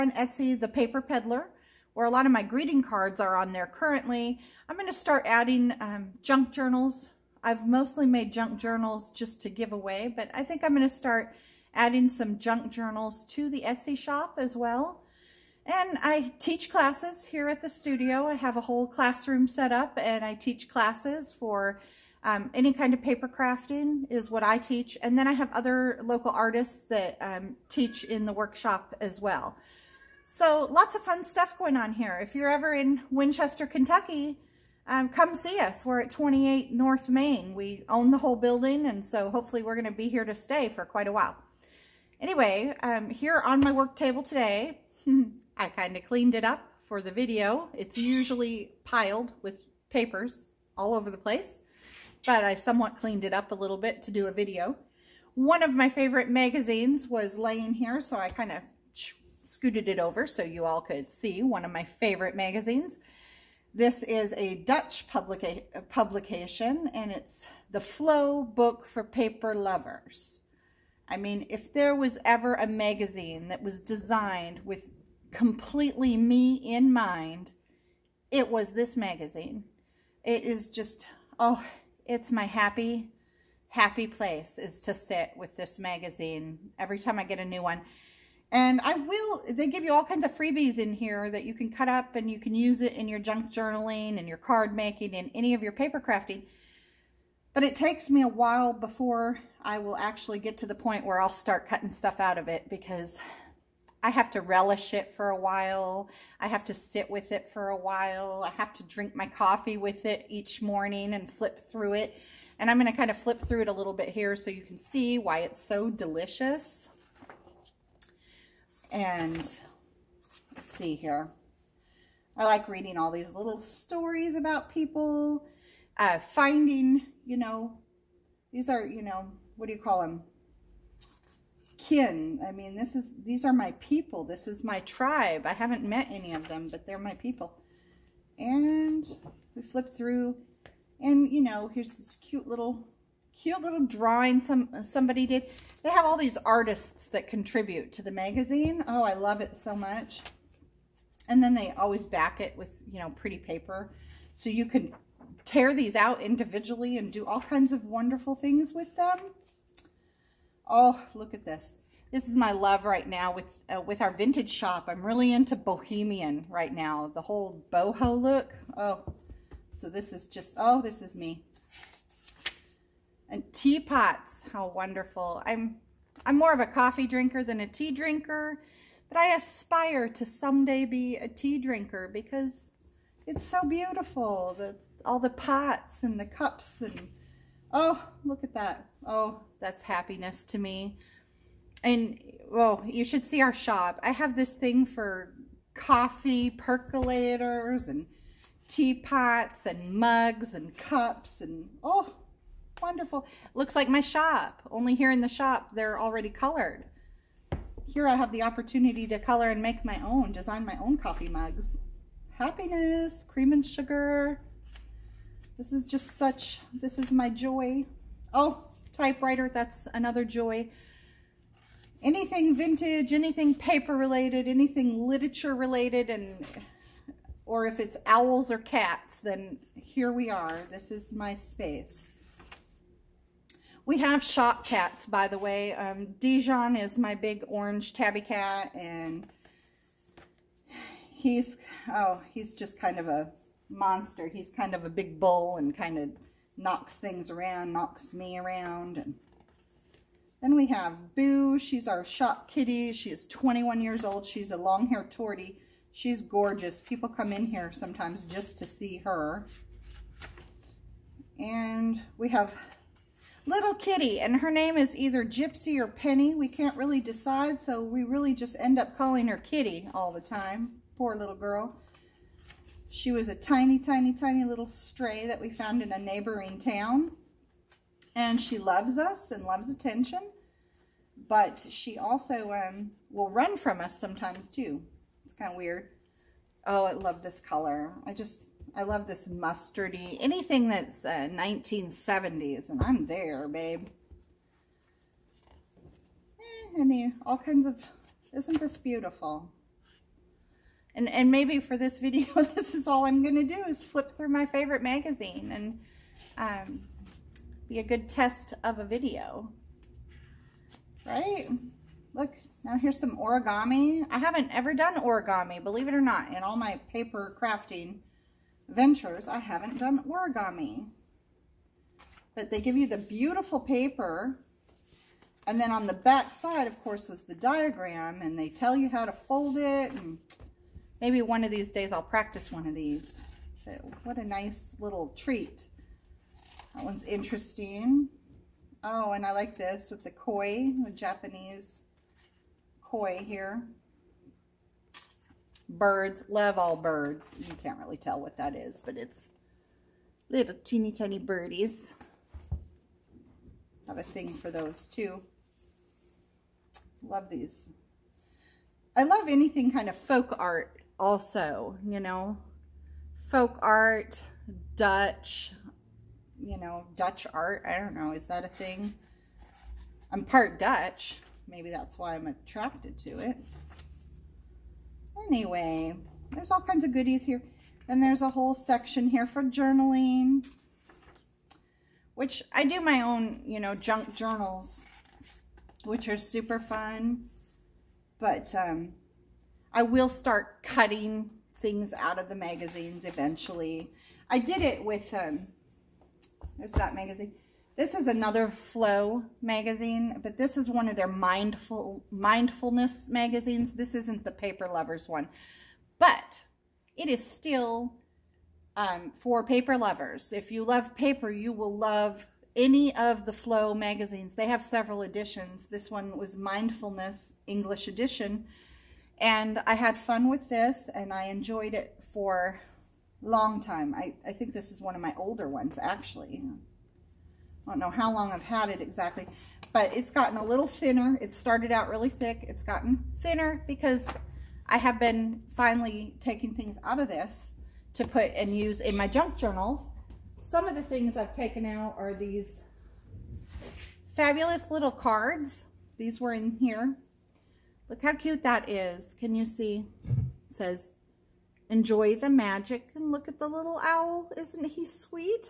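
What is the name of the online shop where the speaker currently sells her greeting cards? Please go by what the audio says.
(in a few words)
The Paper Peddler.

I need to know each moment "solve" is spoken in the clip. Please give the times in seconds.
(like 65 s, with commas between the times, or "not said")
not said.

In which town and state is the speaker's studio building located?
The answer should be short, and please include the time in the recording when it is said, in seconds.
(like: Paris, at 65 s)
Winchester, Kentucky, at 33 s.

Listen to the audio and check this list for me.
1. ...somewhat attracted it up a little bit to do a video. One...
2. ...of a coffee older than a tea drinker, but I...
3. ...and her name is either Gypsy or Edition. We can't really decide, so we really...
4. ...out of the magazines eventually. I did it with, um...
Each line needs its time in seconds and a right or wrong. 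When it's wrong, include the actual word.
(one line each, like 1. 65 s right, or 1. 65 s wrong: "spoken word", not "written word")
1. 52 s wrong: "cleaned", not "attracted"
2. 176 s wrong: "drinker", not "older"
3. 264 s wrong: "Penny", not "Edition"
4. 391 s right.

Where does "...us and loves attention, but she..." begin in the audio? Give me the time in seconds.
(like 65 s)
278 s.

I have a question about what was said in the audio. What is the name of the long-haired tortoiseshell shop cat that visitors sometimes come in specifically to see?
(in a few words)
Boo.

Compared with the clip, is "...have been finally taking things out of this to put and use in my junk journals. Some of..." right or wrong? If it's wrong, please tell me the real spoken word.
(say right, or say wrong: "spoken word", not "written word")
right.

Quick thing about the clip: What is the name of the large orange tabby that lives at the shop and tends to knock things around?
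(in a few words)
Dijon.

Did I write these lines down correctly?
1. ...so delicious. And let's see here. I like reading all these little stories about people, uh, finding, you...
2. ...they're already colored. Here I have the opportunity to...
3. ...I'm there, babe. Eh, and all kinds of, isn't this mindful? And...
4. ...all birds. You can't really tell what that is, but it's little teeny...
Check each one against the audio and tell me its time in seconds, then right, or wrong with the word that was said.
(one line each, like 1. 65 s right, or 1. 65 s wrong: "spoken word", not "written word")
1. 115 s right
2. 205 s right
3. 292 s wrong: "beautiful", not "mindful"
4. 346 s right.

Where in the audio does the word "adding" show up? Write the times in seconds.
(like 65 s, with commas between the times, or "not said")
5 s, 11 s.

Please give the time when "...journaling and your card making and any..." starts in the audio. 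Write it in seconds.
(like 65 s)
93 s.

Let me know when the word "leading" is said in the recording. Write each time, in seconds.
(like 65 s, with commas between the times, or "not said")
not said.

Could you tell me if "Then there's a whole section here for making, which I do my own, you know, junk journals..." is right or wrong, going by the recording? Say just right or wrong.
wrong.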